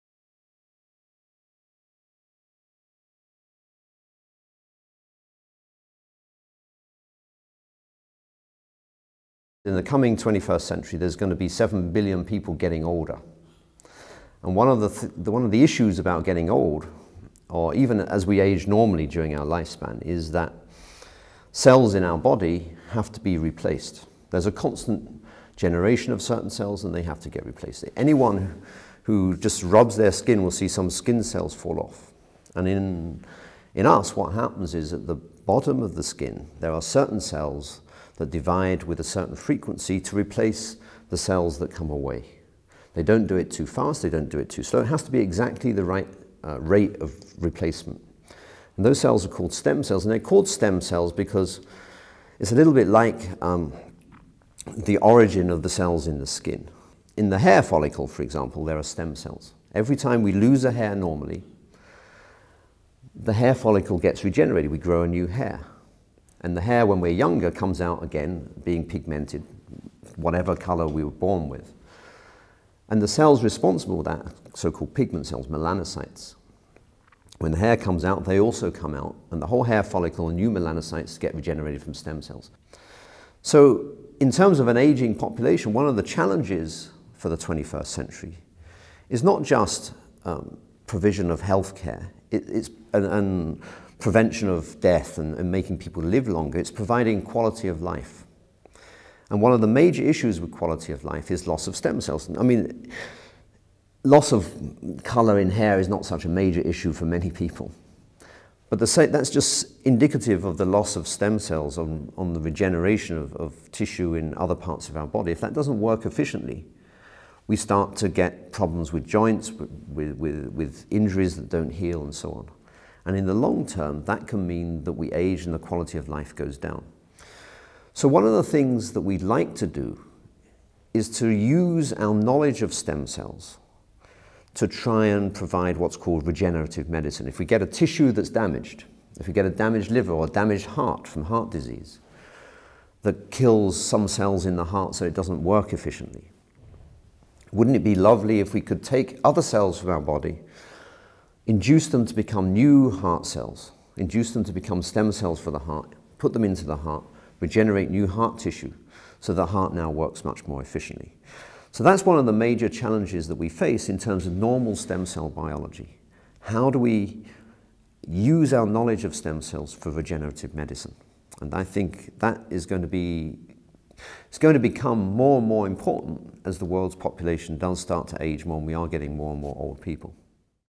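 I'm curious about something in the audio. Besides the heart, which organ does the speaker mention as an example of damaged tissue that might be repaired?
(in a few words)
liver.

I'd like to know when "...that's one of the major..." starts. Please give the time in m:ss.
2:41.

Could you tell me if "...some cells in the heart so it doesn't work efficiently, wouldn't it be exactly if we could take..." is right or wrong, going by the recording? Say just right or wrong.
wrong.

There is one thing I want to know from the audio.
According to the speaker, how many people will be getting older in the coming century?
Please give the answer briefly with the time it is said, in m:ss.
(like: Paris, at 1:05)
7 billion, at 0:11.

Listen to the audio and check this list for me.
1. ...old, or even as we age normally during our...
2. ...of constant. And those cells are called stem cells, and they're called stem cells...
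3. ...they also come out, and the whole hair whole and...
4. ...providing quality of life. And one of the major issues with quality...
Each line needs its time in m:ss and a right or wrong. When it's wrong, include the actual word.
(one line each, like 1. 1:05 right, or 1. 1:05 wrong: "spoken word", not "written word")
1. 0:16 right
2. 0:47 wrong: "replacement", not "constant"
3. 1:18 wrong: "follicle", not "whole"
4. 1:36 right.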